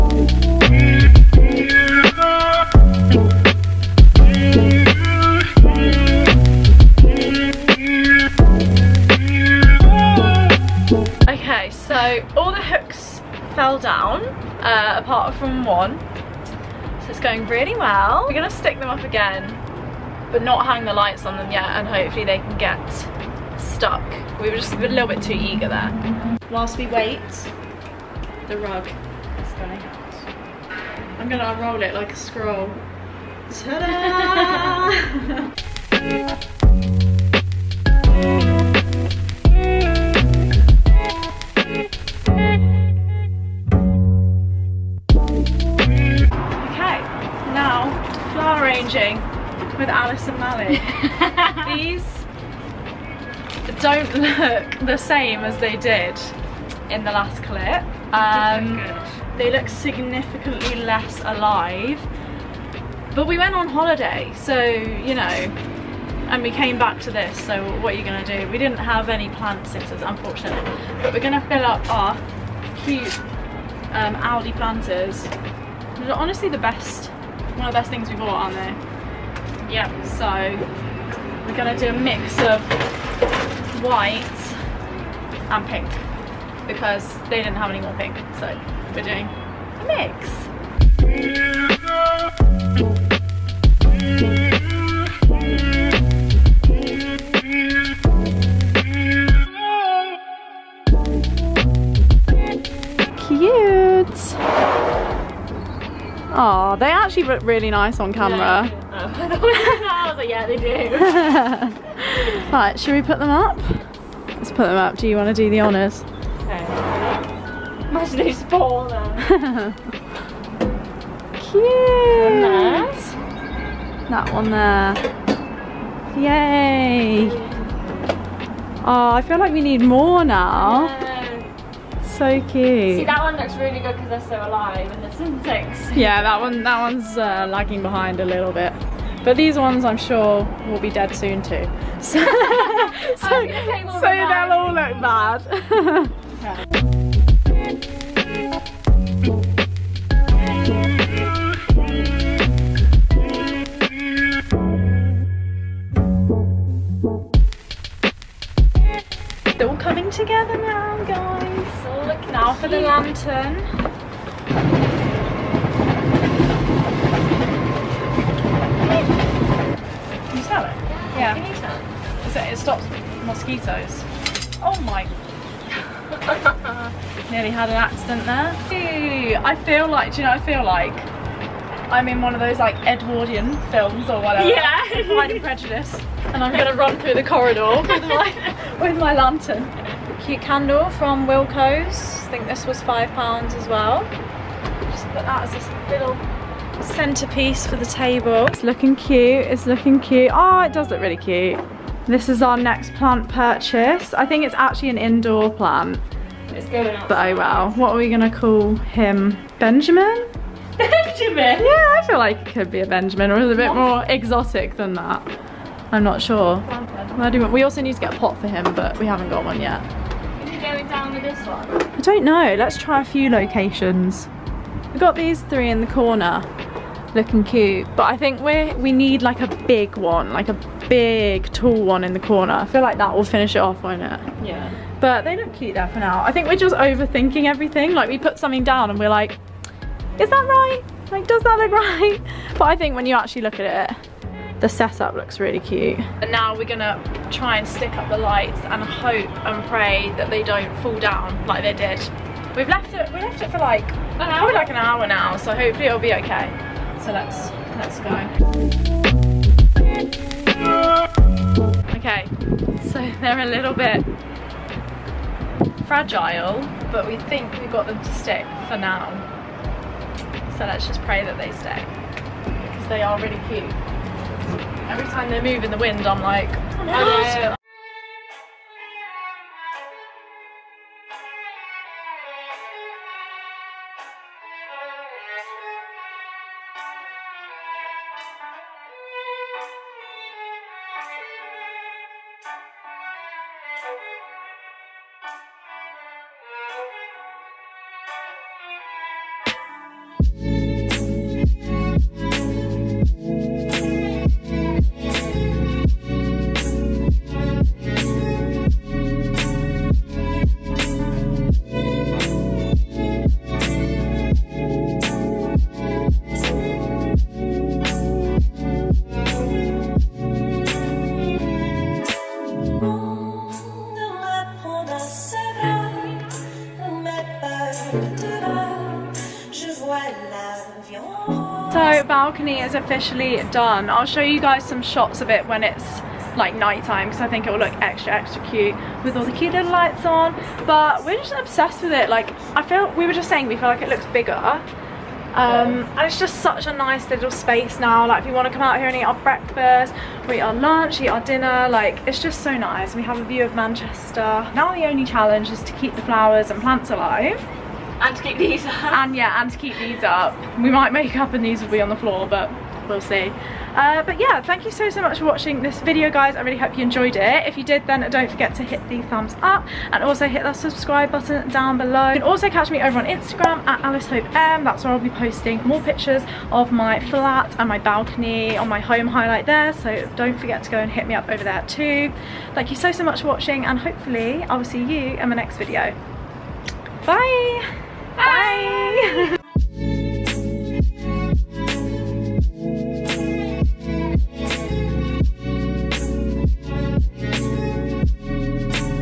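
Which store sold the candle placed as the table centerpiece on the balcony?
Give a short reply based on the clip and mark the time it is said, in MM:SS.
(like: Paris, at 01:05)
Wilko's, at 03:11.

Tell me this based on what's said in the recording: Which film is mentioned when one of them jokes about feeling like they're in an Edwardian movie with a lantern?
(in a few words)
Pride and Prejudice.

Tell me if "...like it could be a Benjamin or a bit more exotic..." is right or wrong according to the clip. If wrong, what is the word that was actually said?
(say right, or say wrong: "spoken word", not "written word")
right.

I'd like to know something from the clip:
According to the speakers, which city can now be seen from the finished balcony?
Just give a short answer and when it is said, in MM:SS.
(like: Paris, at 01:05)
Manchester, at 05:53.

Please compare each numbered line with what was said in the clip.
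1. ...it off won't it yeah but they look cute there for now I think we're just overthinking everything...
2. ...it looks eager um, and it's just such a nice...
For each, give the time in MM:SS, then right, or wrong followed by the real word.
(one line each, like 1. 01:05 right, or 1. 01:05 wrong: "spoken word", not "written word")
1. 03:53 right
2. 05:43 wrong: "bigger", not "eager".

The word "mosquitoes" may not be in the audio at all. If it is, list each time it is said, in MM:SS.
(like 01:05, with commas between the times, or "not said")
02:53.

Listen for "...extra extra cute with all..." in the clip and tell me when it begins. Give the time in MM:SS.
05:37.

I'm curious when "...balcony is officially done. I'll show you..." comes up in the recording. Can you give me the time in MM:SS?
05:32.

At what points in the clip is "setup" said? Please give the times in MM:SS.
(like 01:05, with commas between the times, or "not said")
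04:04.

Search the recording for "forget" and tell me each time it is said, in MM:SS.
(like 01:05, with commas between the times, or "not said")
06:08, 06:20.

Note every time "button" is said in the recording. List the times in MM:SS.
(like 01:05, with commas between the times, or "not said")
02:43, 06:11.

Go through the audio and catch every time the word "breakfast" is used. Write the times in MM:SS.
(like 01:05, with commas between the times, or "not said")
05:49.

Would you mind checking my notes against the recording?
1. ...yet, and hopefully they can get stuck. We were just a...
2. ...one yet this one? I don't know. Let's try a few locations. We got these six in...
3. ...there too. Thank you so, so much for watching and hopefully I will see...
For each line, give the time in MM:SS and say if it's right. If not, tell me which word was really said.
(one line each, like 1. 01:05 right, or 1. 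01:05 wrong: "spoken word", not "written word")
1. 00:21 right
2. 03:39 wrong: "three", not "six"
3. 06:21 right.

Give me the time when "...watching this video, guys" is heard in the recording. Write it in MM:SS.
06:05.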